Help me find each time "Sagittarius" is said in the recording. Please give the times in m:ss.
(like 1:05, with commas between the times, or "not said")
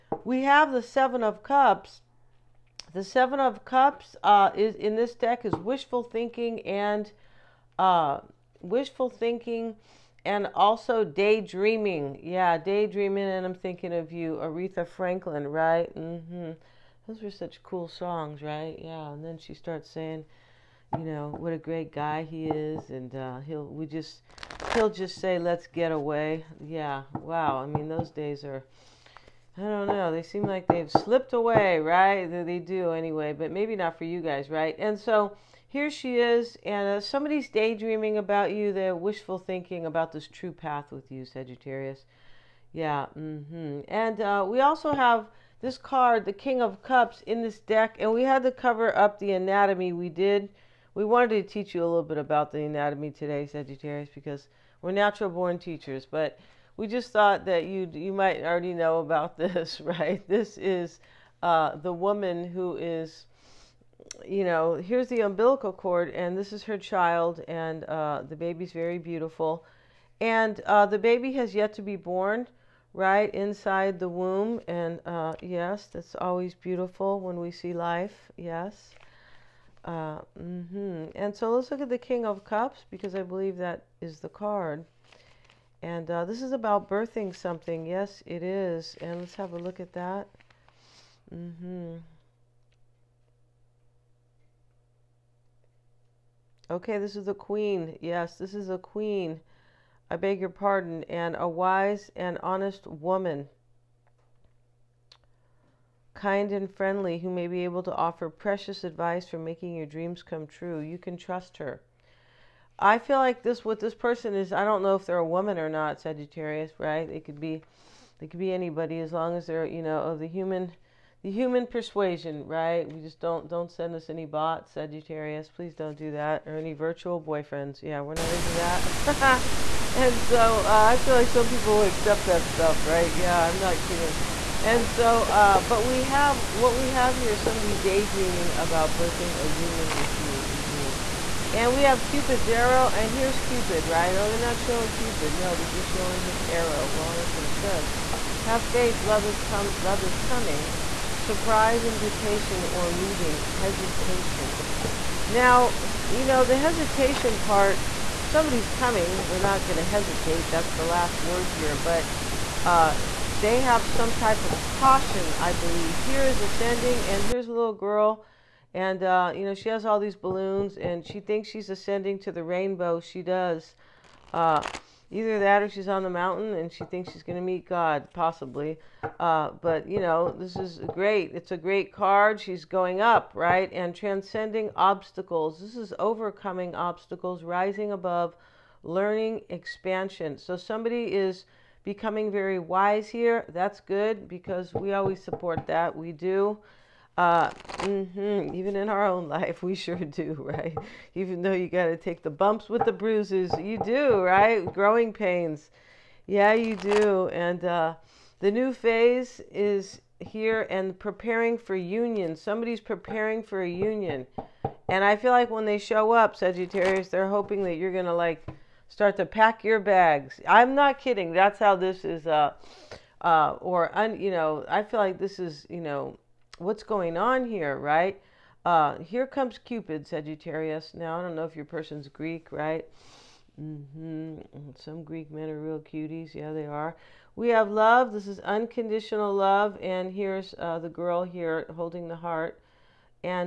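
0:41, 0:53, 1:55, 2:04, 3:36, 3:50.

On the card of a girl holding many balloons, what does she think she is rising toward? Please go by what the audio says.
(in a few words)
The rainbow.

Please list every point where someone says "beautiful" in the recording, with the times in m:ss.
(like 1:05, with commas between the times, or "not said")
1:08, 1:16.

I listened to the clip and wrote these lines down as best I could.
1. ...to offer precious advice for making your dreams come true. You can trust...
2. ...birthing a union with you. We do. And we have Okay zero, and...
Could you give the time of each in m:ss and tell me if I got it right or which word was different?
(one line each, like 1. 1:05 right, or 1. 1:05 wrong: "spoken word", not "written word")
1. 1:47 right
2. 2:18 wrong: "Cupid", not "Okay".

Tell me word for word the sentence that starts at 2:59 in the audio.
Uh, but you know, this is great.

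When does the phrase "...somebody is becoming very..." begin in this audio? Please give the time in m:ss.
3:10.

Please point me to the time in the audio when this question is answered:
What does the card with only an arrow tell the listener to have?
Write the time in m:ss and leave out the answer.
2:28.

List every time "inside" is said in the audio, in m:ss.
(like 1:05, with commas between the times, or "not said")
1:13.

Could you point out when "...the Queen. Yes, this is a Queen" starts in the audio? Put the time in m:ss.
1:37.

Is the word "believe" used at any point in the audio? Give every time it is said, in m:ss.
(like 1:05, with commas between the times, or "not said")
1:23, 2:45.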